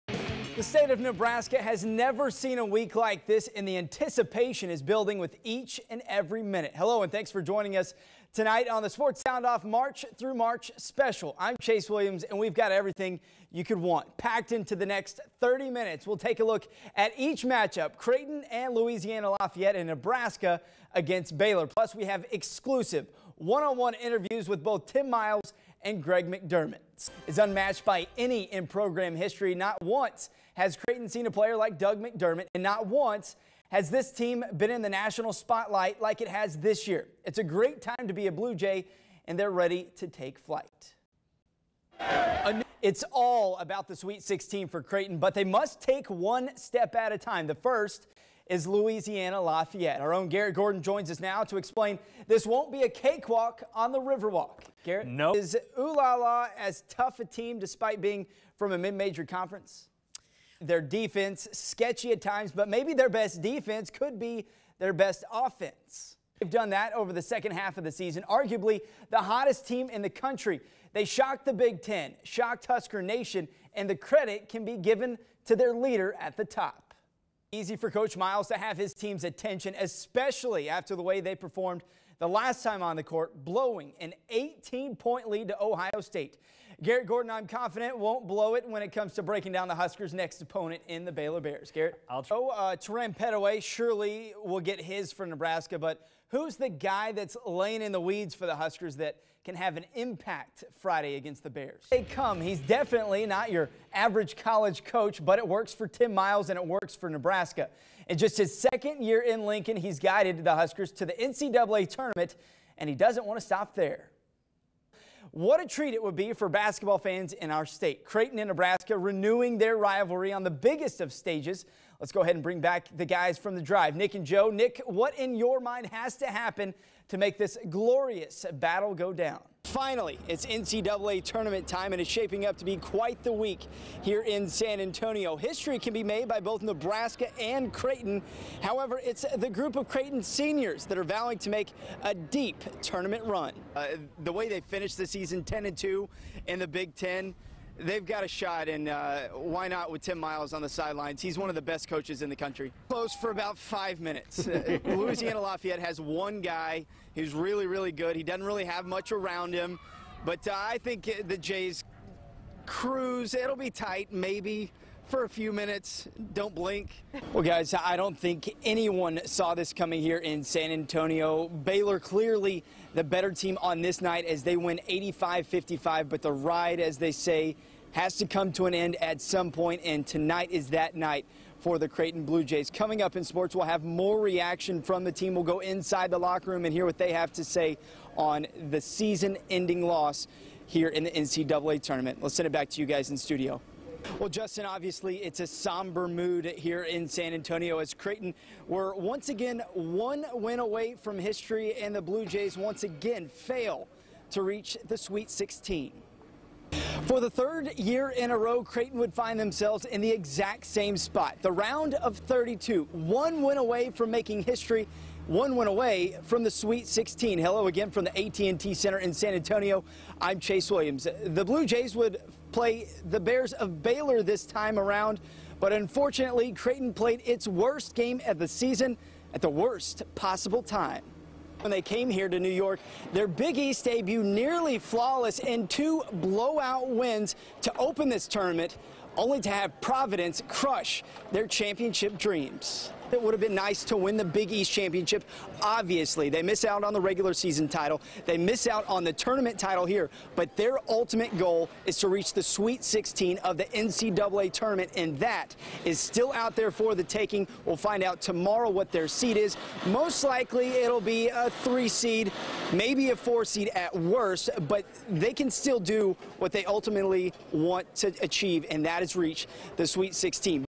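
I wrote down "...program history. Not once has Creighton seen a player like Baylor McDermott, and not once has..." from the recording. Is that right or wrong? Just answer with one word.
wrong.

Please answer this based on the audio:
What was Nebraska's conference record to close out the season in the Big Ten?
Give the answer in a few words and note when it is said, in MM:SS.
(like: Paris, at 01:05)
10 and 2, at 02:25.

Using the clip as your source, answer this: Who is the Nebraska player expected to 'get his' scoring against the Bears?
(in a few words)
Terran Petteway.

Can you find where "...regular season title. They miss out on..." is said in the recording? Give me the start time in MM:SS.
04:07.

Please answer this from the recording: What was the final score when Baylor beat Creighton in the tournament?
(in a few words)
85-55.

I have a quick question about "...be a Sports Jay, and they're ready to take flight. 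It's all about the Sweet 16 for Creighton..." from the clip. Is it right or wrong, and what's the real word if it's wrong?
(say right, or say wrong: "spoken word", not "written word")
wrong: "Blue", not "Sports".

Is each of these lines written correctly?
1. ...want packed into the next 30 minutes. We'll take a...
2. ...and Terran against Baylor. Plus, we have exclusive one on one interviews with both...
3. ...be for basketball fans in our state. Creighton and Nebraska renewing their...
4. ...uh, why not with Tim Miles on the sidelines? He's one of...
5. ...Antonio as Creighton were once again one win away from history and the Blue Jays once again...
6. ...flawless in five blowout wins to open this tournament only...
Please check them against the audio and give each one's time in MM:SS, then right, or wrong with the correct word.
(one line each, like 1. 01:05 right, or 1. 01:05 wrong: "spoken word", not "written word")
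1. 00:13 right
2. 00:19 wrong: "Nebraska", not "Terran"
3. 01:56 right
4. 02:28 right
5. 03:17 right
6. 03:54 wrong: "two", not "five".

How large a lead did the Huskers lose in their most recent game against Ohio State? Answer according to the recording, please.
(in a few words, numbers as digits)
18.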